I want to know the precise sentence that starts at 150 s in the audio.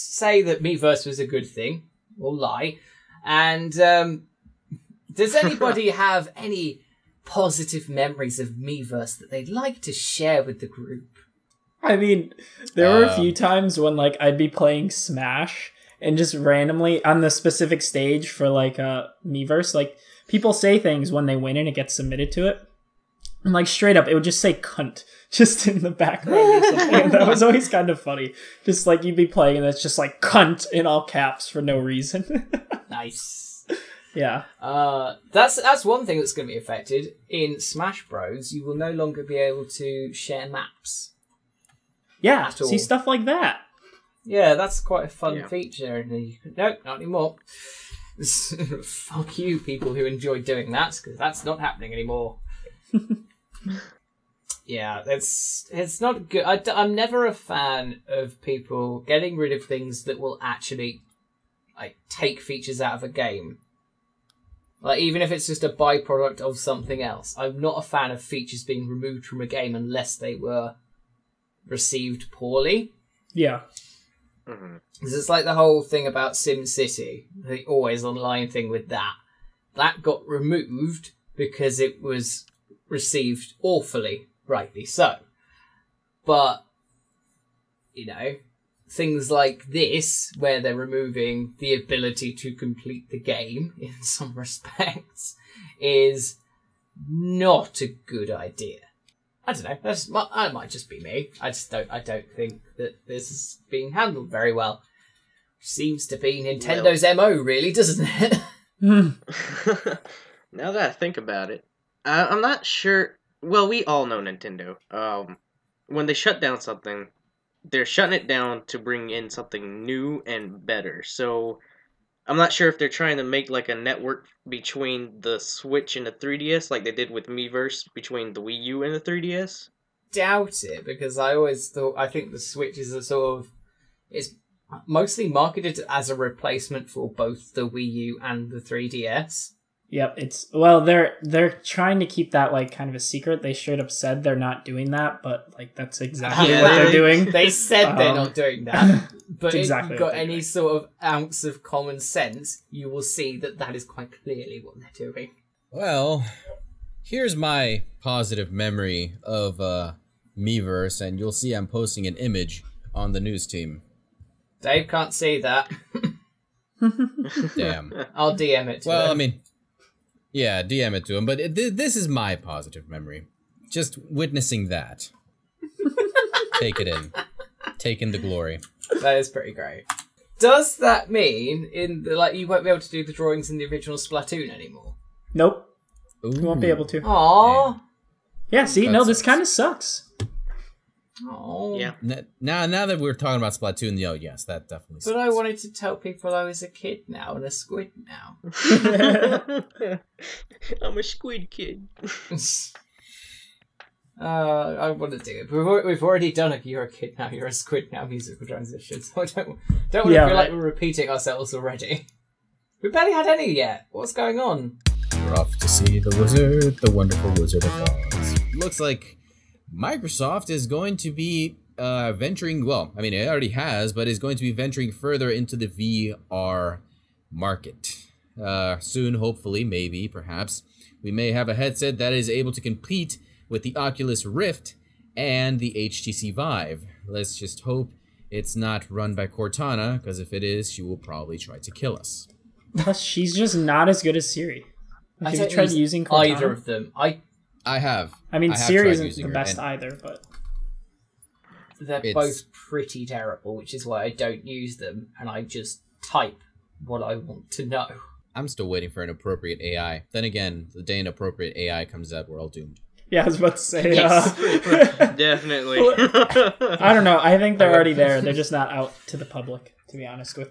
sort of ounce of common sense, you will see that that is quite clearly what they're doing.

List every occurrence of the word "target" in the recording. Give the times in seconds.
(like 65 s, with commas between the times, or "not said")
not said.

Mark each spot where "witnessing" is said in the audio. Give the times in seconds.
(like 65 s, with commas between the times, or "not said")
174 s.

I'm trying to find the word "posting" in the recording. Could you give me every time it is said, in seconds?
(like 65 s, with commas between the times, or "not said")
161 s.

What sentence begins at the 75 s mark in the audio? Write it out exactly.
It's like the whole thing about SimCity, the always online thing with that.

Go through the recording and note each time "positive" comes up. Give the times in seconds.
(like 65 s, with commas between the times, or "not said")
7 s, 158 s, 172 s.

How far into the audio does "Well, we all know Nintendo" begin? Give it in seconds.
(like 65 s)
113 s.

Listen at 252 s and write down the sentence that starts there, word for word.
both pretty terrible, which is why I don't use them, and I just type what I want to know.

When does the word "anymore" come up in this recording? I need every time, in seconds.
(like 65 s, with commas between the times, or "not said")
46 s, 51 s, 184 s.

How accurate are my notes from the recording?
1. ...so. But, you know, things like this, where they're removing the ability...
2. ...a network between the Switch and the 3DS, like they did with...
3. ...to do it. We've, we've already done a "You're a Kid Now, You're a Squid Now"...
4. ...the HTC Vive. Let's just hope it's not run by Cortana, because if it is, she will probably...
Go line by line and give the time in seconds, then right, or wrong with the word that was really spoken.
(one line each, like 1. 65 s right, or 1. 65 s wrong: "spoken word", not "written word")
1. 84 s right
2. 123 s right
3. 205 s right
4. 235 s right.